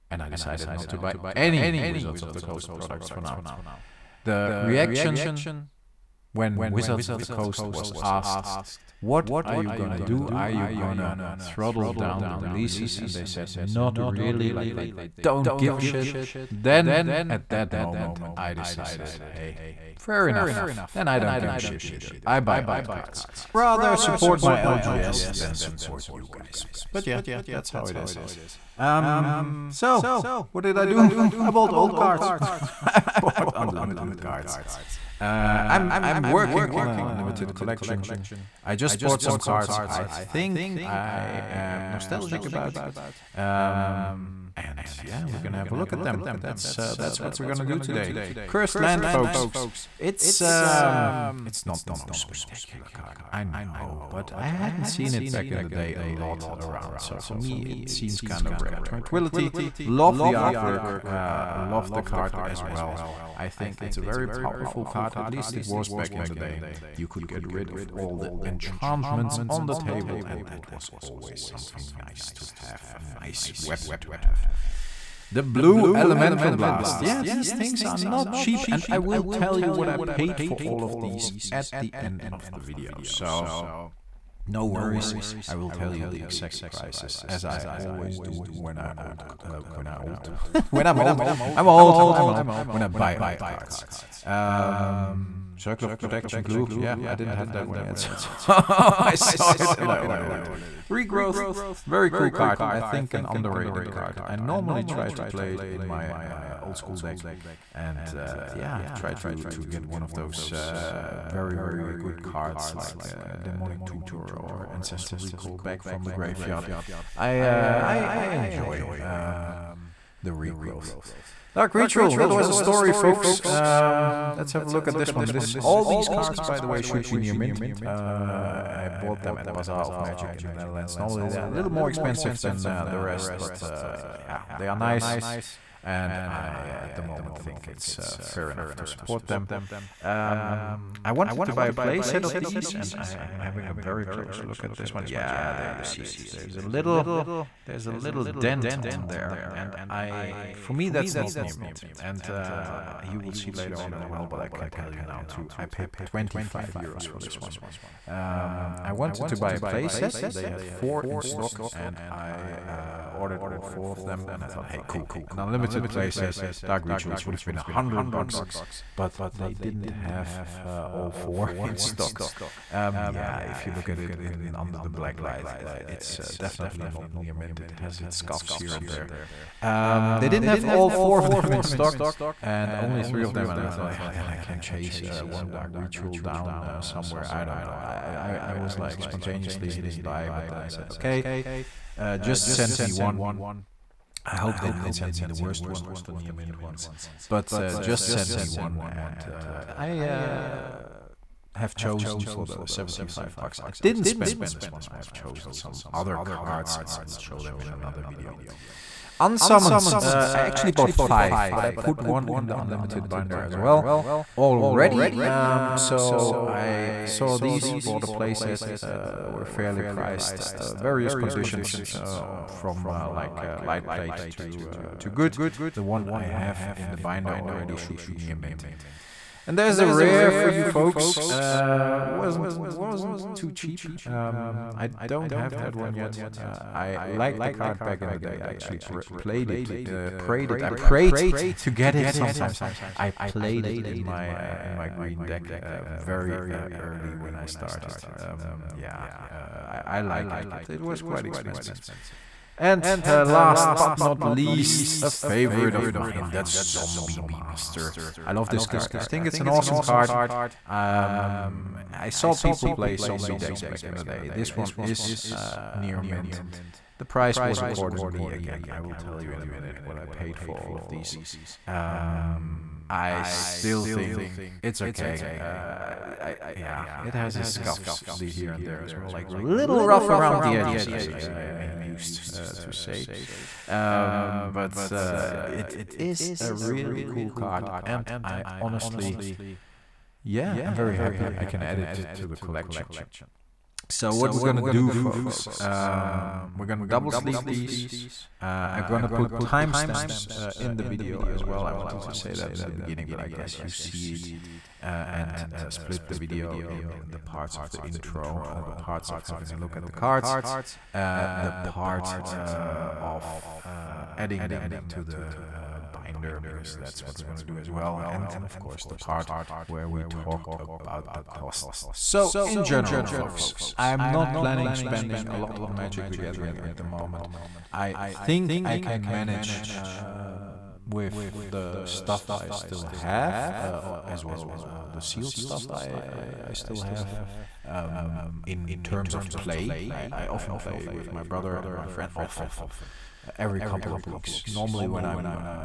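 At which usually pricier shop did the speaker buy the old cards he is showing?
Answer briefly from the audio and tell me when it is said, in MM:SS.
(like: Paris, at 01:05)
Bazaar of Magic, at 02:09.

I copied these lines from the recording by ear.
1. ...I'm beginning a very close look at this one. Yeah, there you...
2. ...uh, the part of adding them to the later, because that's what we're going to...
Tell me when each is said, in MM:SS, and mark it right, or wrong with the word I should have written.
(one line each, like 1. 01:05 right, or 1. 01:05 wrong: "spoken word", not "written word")
1. 02:22 wrong: "having", not "beginning"
2. 05:10 wrong: "binder", not "later".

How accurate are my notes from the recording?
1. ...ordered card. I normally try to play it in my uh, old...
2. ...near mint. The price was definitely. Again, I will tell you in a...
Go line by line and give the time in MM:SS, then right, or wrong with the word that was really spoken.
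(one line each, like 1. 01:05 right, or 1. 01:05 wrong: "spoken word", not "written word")
1. 01:43 wrong: "underrated", not "ordered"
2. 04:25 wrong: "accordingly", not "definitely".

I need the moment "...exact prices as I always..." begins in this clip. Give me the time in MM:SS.
01:26.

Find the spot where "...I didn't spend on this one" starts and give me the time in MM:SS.
03:23.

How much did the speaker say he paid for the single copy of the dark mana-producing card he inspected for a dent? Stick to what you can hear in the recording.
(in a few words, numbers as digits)
25 euros.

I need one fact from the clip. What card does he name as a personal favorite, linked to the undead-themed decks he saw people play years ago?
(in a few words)
Zombie Master.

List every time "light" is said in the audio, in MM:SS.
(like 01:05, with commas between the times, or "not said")
02:55, 03:43.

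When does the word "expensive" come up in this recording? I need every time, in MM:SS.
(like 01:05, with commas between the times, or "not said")
02:11, 04:11.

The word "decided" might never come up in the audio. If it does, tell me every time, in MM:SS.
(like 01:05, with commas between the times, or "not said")
00:00, 00:18.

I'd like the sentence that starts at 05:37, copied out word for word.
Um, in terms of play, I, I often play with my brother and my friend, often every couple of weeks.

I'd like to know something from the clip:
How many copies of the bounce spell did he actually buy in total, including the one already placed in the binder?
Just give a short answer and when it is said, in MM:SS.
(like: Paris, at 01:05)
5, at 03:30.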